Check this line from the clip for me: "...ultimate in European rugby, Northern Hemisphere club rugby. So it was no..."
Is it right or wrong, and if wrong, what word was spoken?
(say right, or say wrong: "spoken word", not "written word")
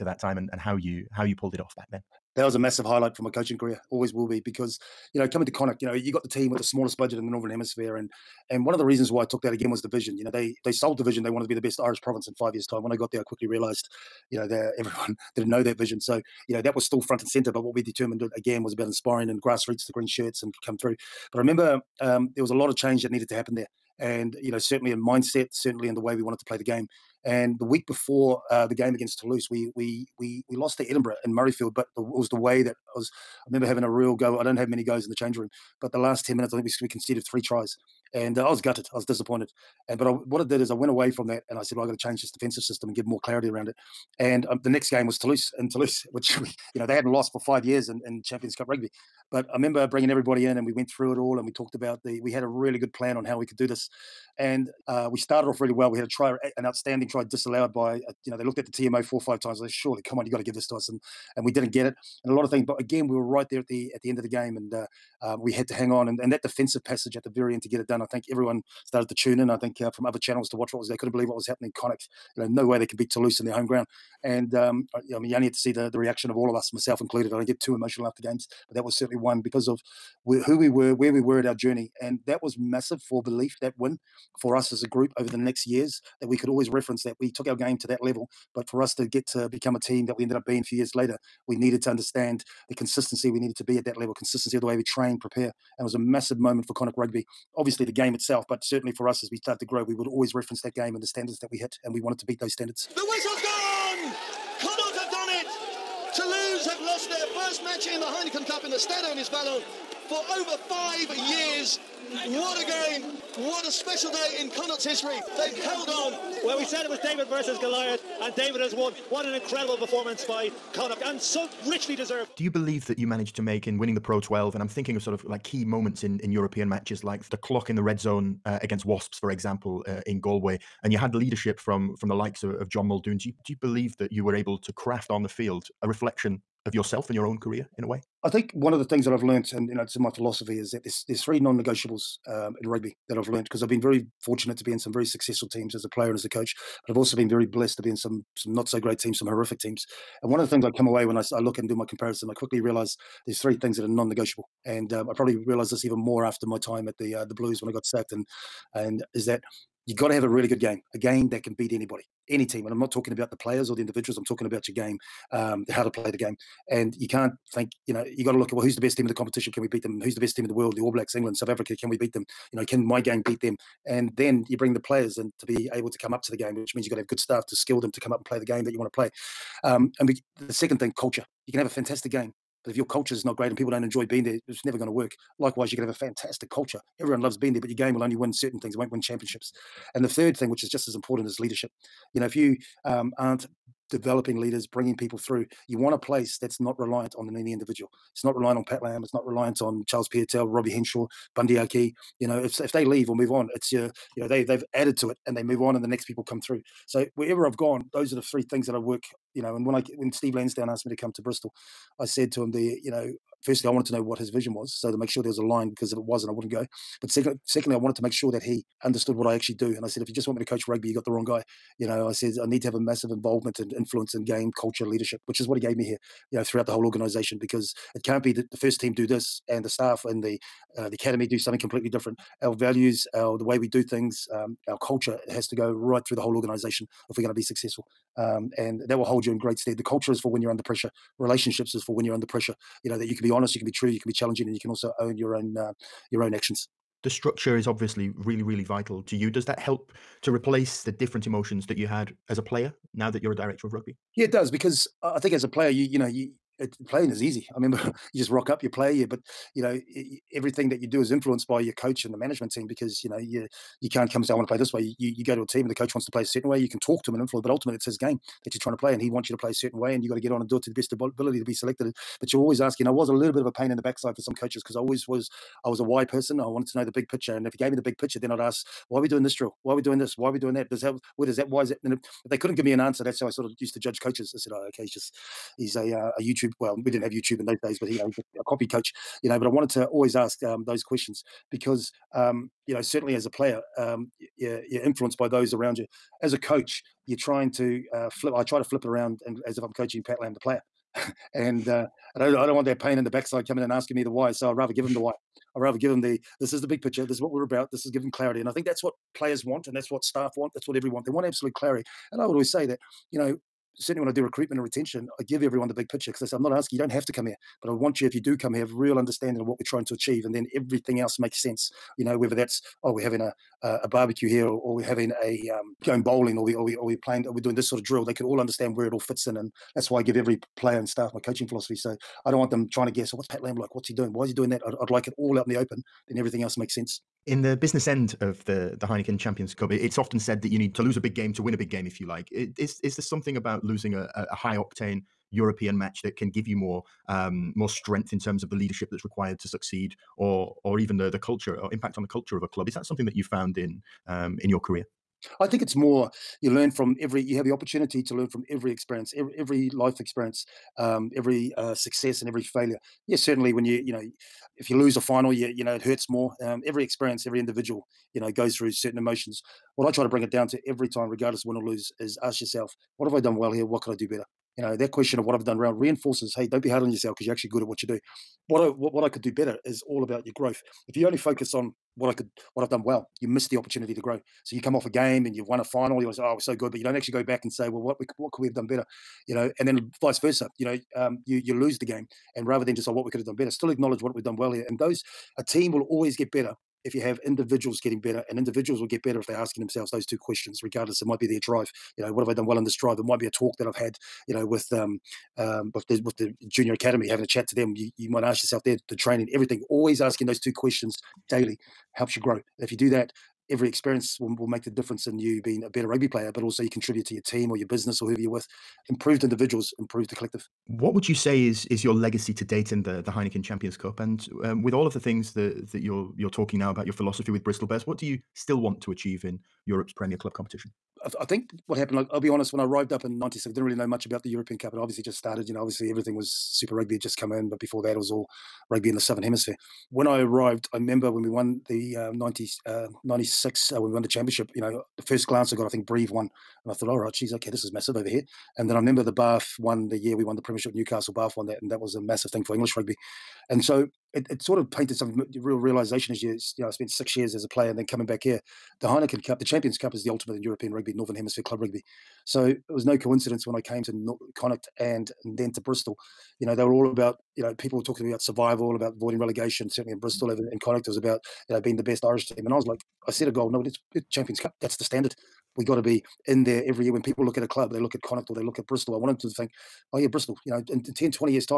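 right.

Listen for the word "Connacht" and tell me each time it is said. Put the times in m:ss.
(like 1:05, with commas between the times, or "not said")
0:05, 1:11, 1:36, 1:54, 2:00, 7:44, 7:50, 7:58.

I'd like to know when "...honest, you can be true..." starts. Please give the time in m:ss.
4:03.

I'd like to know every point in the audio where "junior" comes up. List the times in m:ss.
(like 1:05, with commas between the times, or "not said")
6:46.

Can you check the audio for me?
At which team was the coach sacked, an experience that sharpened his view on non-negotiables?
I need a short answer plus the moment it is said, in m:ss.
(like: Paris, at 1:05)
the Blues, at 2:37.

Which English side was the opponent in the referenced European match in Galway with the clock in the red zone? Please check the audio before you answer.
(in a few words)
Wasps.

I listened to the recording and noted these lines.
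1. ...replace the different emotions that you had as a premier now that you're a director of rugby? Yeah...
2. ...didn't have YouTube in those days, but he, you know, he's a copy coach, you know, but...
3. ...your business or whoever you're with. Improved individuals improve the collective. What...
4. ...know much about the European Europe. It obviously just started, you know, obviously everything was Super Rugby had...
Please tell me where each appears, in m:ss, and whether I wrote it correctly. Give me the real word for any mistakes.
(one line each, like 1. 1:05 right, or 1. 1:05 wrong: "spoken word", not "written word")
1. 4:10 wrong: "player", not "premier"
2. 4:46 right
3. 6:57 right
4. 7:13 wrong: "Cup", not "Europe".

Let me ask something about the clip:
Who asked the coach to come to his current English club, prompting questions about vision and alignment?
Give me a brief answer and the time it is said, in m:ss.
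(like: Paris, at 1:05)
Steve Lansdown, at 3:30.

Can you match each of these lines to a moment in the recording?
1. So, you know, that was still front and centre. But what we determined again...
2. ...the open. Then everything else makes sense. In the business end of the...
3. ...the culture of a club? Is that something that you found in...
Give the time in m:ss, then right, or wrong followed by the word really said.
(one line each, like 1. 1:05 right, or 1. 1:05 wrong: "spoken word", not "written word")
1. 0:15 right
2. 5:35 right
3. 5:52 right.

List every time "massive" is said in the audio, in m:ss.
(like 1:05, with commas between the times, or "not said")
0:02, 1:22, 1:35, 3:42, 7:27, 7:32.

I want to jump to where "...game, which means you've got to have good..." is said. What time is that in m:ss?
2:56.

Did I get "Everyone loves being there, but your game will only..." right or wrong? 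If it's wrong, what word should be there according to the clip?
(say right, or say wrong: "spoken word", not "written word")
right.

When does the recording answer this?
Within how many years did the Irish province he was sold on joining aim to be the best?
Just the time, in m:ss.
0:12.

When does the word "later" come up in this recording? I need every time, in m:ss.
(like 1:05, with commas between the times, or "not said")
1:30.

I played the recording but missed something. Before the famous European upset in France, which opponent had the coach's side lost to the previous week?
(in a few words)
Edinburgh.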